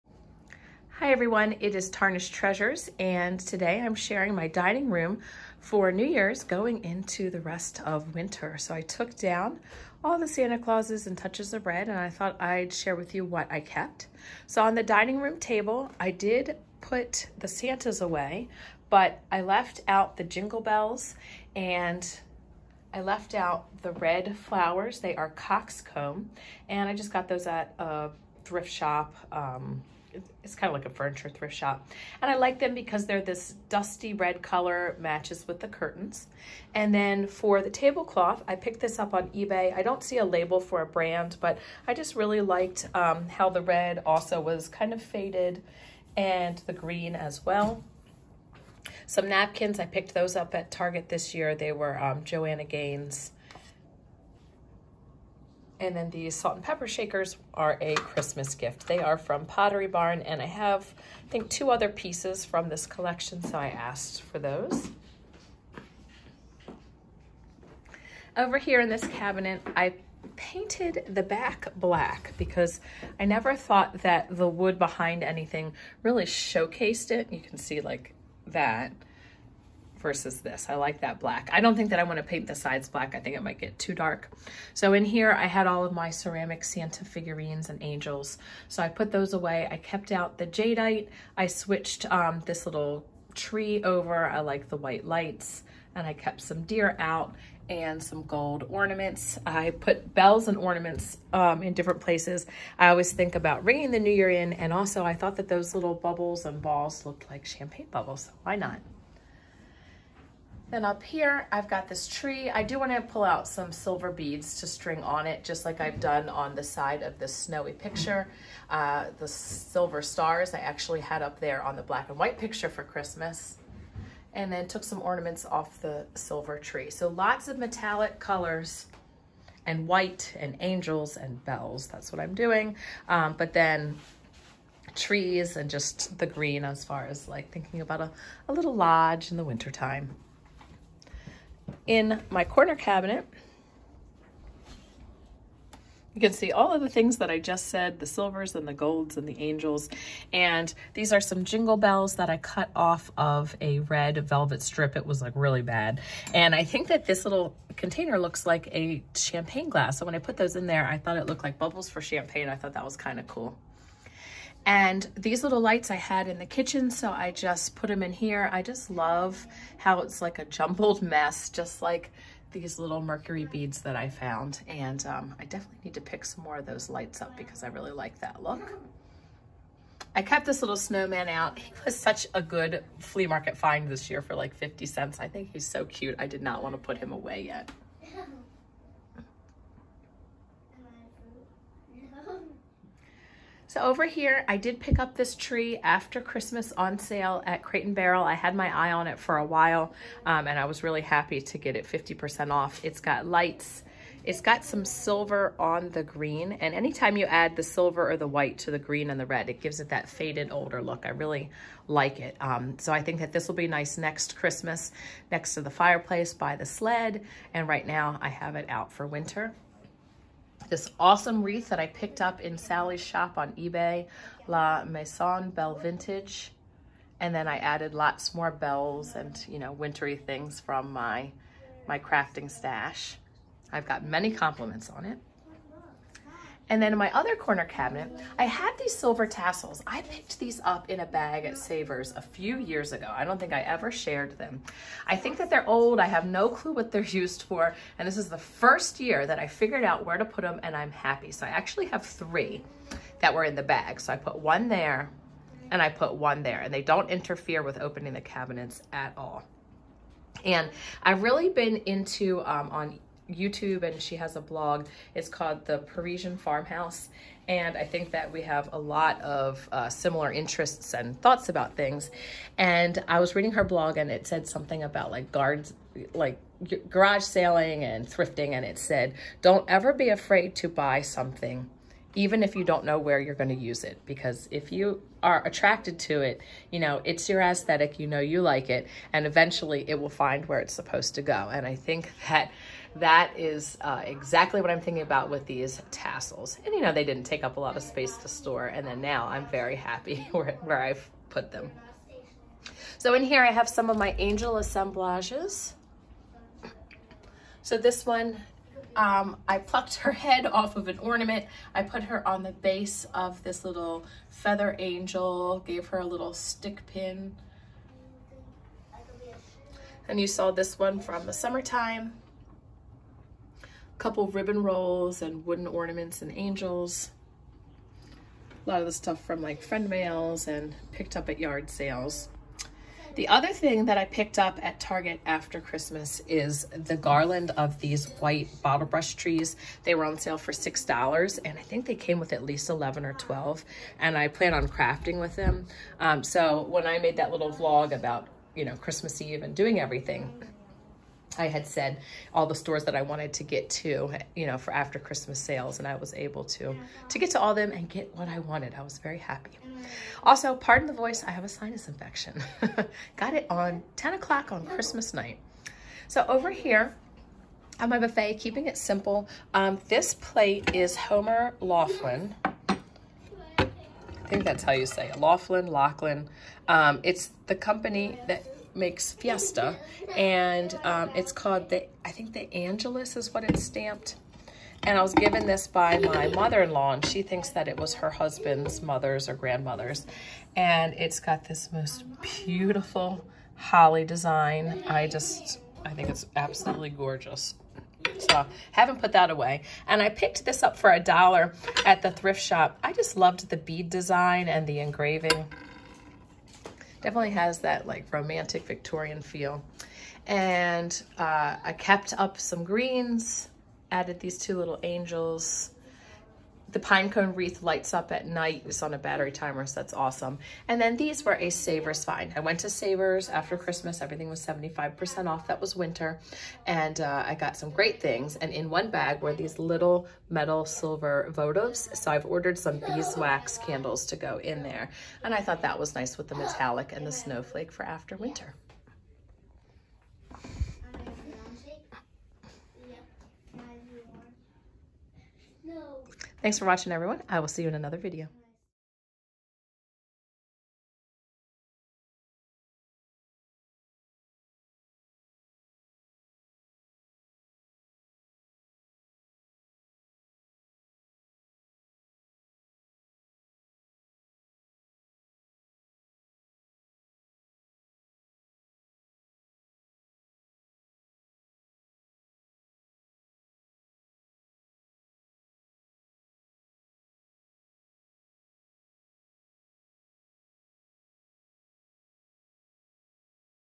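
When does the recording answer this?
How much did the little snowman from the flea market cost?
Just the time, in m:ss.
3:04.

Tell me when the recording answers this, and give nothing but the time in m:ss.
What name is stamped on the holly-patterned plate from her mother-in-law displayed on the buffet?
6:22.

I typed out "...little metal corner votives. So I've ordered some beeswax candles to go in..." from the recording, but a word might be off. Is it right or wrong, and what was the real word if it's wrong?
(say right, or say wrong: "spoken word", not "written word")
wrong: "silver", not "corner".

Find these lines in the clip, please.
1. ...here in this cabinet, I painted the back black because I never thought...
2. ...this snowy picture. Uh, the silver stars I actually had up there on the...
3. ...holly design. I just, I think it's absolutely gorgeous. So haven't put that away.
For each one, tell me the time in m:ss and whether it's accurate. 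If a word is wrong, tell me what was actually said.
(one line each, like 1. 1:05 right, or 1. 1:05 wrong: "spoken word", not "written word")
1. 1:08 right
2. 1:57 right
3. 6:33 right.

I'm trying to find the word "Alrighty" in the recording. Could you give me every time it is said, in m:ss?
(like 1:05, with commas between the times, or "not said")
not said.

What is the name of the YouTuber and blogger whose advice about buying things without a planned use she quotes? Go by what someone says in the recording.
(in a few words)
The Parisian Farmhouse.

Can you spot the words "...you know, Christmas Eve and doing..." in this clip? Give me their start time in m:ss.
5:48.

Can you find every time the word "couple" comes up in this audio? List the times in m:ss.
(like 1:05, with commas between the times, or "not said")
5:23.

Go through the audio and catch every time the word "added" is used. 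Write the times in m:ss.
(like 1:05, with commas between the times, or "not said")
3:47, 6:53.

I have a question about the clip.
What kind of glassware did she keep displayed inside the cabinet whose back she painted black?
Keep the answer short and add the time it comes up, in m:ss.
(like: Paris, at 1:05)
Jadeite, at 1:30.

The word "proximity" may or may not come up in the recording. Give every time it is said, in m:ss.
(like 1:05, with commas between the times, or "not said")
not said.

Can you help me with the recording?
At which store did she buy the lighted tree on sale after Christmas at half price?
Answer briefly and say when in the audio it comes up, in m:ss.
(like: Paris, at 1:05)
Crate and Barrel, at 3:17.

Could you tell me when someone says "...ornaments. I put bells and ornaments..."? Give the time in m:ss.
1:38.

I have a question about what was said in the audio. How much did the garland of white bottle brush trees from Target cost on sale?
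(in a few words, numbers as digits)
$6.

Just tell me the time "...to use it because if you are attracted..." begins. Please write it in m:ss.
4:43.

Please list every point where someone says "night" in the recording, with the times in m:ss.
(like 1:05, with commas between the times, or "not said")
6:05, 6:58.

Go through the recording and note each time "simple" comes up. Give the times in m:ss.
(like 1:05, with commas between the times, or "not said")
6:08.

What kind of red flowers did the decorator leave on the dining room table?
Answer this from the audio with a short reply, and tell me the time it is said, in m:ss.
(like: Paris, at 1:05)
Coxcomb, at 0:25.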